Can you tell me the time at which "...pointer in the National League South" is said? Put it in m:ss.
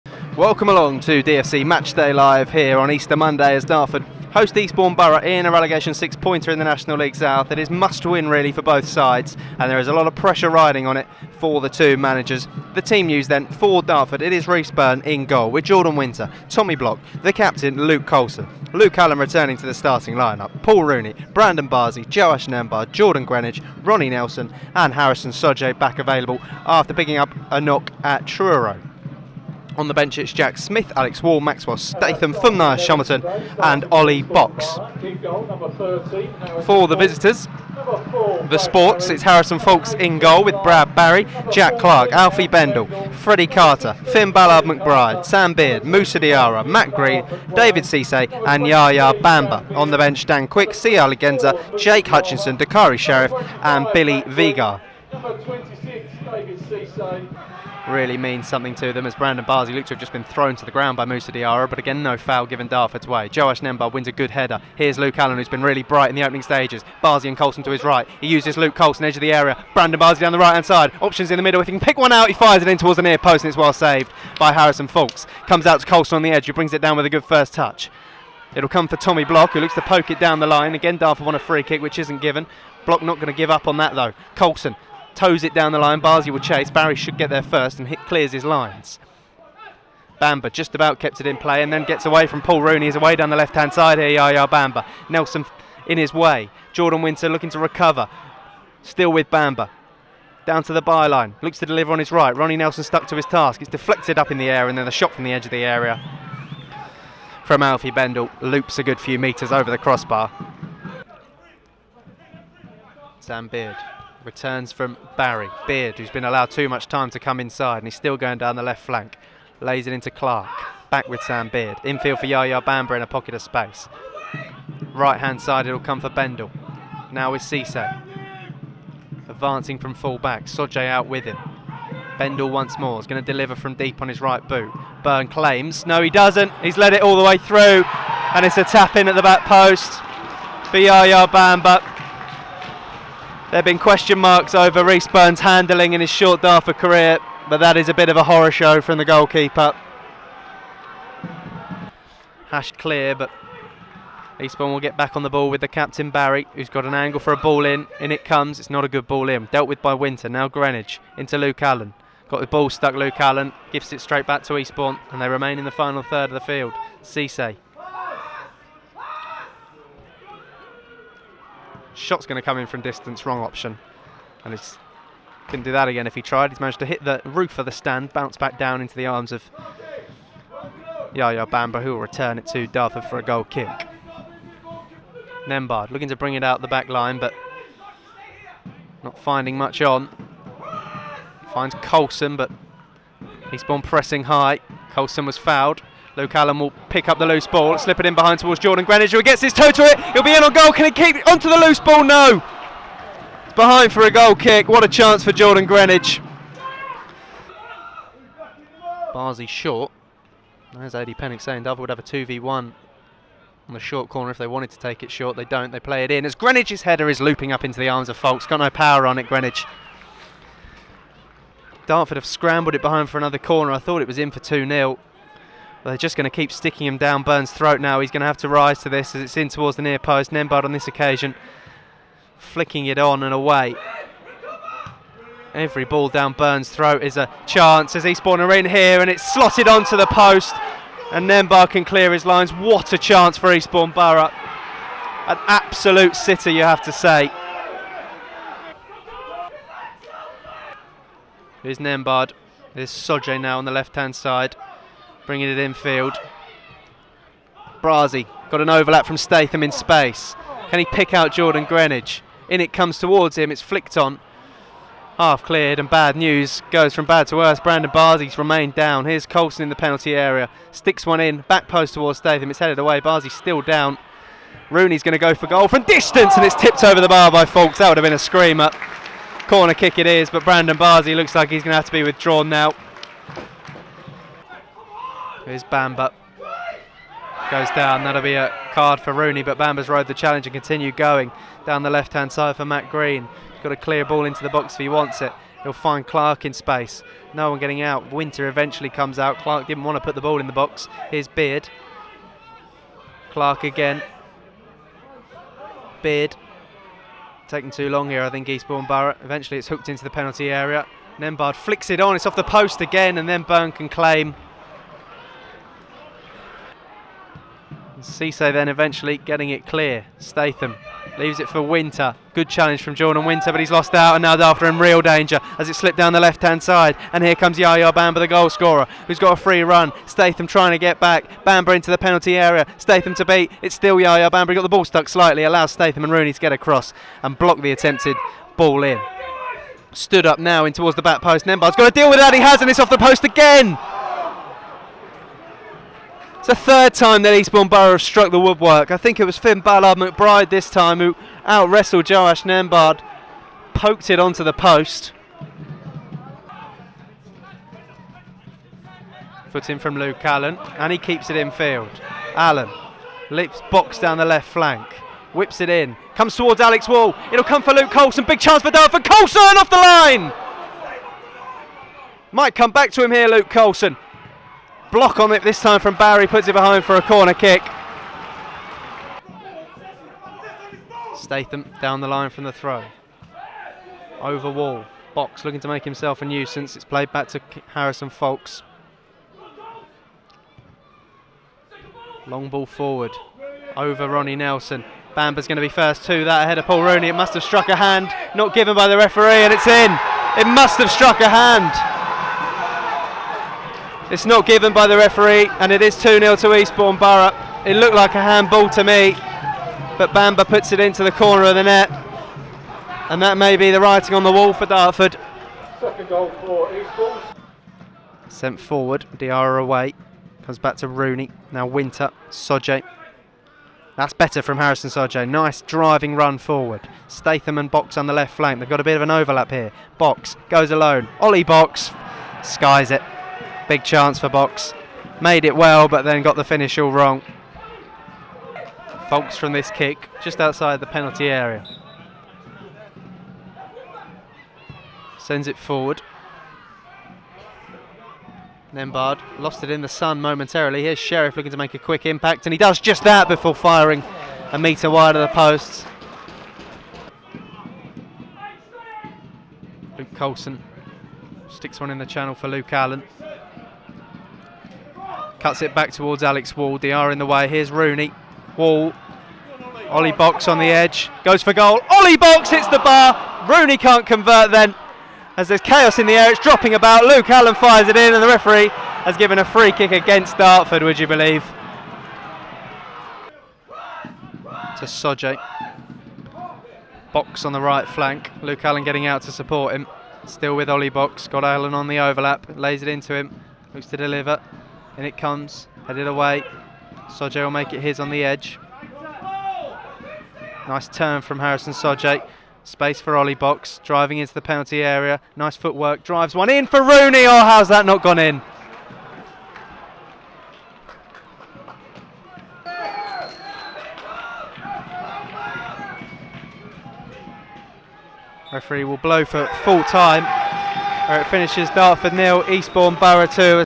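0:06.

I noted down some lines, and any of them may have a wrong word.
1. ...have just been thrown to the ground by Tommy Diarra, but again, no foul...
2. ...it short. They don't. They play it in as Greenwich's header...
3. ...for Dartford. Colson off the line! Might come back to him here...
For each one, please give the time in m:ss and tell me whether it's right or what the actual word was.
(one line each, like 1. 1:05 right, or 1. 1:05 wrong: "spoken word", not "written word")
1. 0:59 wrong: "Musa", not "Tommy"
2. 3:35 right
3. 6:08 right.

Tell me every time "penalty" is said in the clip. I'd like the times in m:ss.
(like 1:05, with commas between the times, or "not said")
4:29, 5:10, 5:31, 7:20, 8:24.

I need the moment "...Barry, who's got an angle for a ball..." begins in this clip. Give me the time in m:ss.
2:36.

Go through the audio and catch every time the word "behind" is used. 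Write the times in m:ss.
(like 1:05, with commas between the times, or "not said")
3:18, 3:23, 3:42, 6:16.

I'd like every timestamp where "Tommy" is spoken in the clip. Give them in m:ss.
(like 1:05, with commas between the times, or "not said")
0:16, 1:18.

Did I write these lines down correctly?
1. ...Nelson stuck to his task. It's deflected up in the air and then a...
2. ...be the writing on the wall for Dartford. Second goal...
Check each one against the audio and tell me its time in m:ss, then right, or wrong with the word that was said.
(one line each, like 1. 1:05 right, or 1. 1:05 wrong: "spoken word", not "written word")
1. 1:42 right
2. 6:53 right.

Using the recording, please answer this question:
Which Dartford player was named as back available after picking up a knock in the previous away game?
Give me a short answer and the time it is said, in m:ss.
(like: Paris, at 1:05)
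Harrison Soje, at 0:24.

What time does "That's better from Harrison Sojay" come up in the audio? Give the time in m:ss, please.
7:03.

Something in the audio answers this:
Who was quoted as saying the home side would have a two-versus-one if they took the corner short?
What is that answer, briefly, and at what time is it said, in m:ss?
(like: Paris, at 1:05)
Eddie Pennock, at 3:30.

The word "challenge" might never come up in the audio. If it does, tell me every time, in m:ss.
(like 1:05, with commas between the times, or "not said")
4:50, 5:22.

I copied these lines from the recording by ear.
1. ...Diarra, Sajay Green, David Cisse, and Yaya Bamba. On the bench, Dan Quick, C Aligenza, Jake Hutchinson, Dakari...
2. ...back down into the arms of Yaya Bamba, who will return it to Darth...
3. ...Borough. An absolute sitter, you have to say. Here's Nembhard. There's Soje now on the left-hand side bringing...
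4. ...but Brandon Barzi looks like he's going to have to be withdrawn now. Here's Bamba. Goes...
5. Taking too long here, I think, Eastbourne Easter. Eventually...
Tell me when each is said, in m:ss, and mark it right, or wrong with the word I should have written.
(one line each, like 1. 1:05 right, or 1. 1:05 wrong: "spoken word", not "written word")
1. 0:46 wrong: "Matt", not "Sajay"
2. 2:58 right
3. 4:03 right
4. 4:40 right
5. 5:07 wrong: "Borough", not "Easter".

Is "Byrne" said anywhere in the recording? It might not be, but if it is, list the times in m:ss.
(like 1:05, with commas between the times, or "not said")
0:14, 2:15, 2:25, 5:13.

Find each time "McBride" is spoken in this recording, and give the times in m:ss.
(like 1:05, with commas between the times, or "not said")
0:44, 5:49.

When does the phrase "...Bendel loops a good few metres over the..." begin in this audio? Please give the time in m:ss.
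1:47.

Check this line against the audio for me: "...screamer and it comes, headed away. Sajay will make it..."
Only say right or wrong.
wrong.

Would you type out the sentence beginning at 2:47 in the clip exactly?
Cisse Shot's going to come in from distance, wrong option.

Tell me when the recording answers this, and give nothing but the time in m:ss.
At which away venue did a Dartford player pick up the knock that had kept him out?
0:28.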